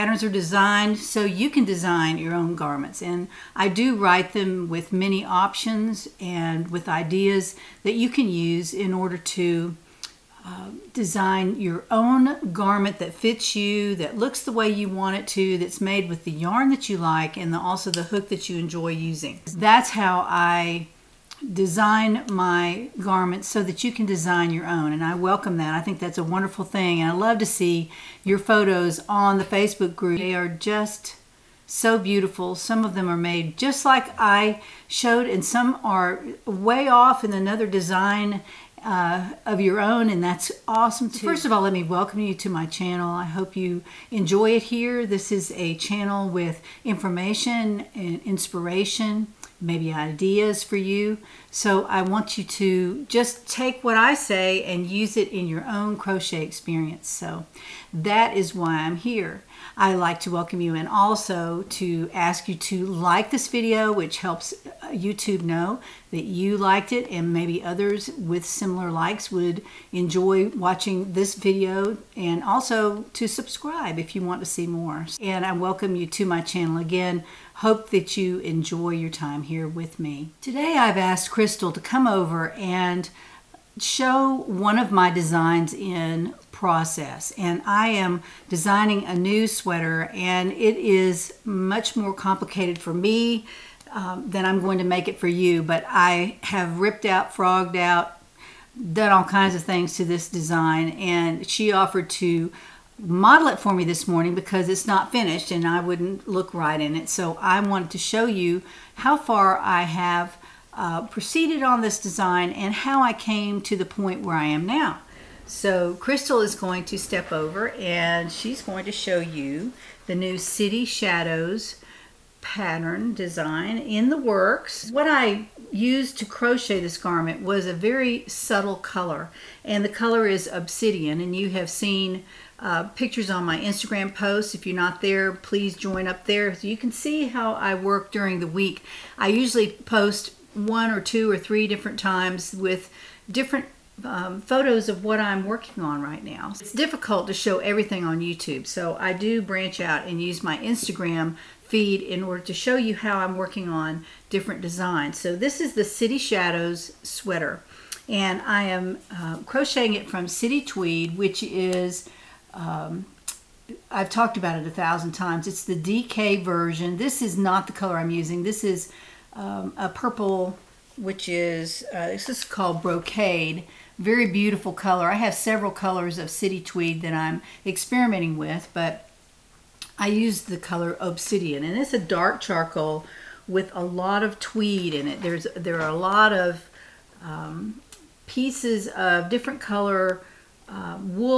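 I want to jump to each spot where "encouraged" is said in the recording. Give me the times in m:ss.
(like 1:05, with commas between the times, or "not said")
not said.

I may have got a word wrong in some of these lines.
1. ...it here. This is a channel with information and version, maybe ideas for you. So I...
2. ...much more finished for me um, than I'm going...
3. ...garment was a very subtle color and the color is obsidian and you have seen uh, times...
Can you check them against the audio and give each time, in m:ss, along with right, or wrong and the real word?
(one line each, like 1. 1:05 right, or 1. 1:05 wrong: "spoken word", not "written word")
1. 0:44 wrong: "inspiration", not "version"
2. 1:31 wrong: "complicated", not "finished"
3. 2:06 wrong: "pictures", not "times".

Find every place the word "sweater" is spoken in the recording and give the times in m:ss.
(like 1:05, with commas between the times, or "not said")
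1:29, 2:37.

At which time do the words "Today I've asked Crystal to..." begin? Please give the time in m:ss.
1:20.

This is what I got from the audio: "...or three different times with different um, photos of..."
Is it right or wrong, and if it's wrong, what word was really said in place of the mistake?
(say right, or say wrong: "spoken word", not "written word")
right.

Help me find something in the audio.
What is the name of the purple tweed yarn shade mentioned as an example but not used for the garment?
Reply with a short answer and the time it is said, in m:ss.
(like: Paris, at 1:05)
Brocade, at 2:52.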